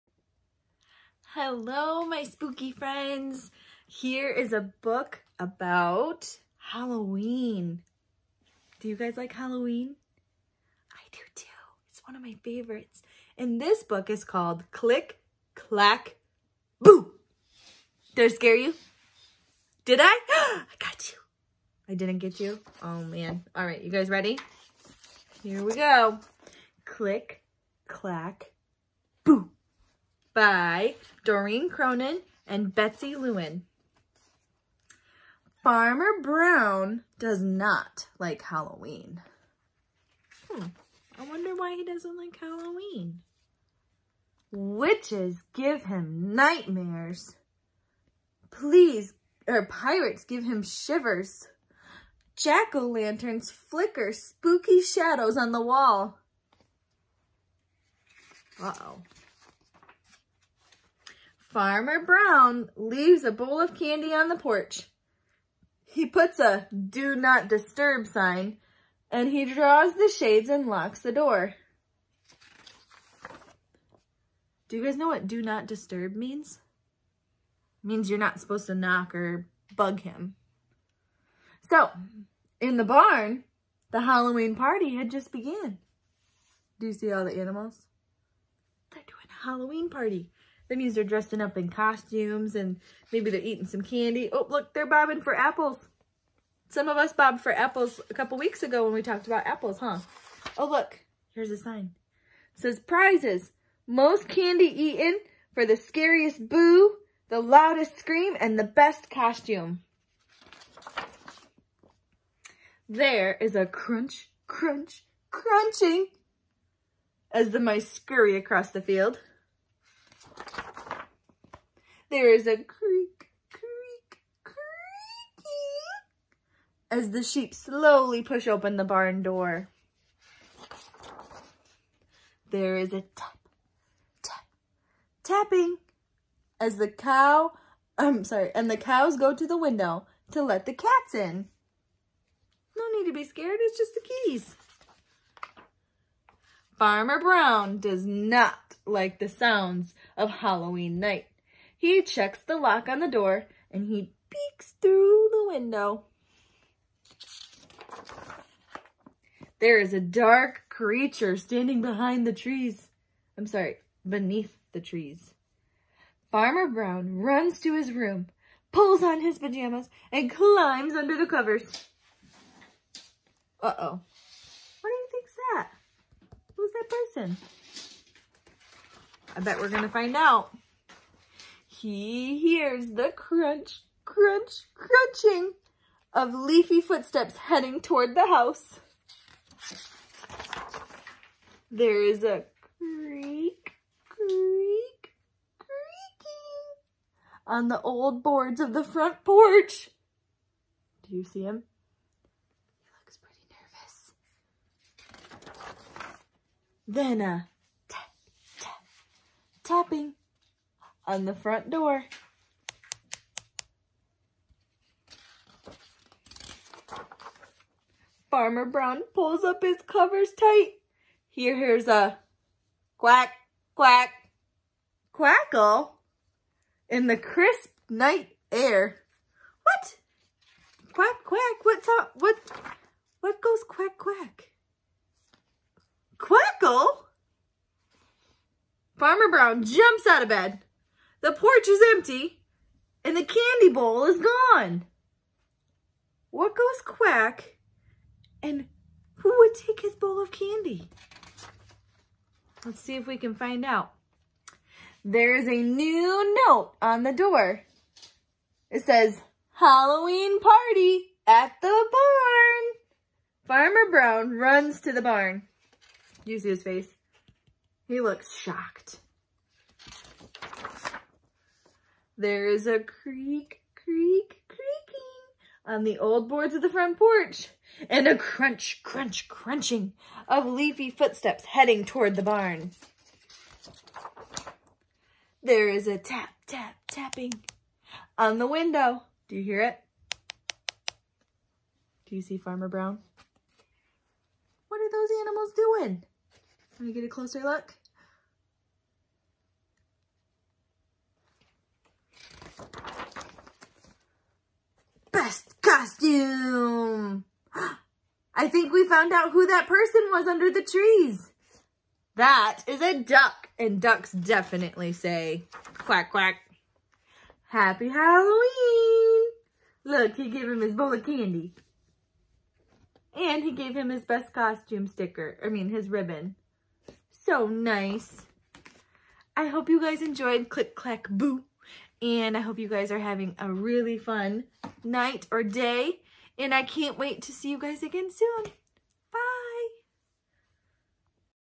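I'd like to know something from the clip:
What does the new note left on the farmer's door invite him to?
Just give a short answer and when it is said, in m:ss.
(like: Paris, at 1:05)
Halloween party at the barn, at 4:19.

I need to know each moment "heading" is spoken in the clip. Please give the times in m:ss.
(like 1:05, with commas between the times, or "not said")
3:07, 4:41.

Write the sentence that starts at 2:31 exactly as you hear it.
He checks the lock on the door and he peeks through the window.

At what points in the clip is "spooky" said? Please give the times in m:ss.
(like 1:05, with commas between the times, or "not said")
0:02, 0:54.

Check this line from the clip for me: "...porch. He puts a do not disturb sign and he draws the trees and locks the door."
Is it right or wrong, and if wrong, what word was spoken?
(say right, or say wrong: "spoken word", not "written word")
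wrong: "shades", not "trees".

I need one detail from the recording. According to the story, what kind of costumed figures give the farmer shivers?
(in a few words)
Pirates.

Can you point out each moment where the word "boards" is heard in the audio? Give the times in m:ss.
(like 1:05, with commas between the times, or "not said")
3:18, 4:36.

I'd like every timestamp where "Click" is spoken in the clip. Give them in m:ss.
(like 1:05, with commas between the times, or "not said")
0:14, 0:26, 5:30.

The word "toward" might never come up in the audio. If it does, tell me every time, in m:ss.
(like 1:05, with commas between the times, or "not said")
3:07, 4:41.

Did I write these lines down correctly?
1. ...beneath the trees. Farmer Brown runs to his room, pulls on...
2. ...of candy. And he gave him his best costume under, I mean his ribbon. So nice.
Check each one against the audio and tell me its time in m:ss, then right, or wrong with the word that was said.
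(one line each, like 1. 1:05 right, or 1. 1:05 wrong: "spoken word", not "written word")
1. 2:44 right
2. 5:20 wrong: "sticker", not "under".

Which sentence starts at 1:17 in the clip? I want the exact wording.
It means you're not supposed to knock or bug him.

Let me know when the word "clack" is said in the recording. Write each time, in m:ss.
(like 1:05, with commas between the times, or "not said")
0:15, 0:27, 5:30.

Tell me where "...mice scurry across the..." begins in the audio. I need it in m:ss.
1:57.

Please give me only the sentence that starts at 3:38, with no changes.
Farmer Brown pulls up his covers tight.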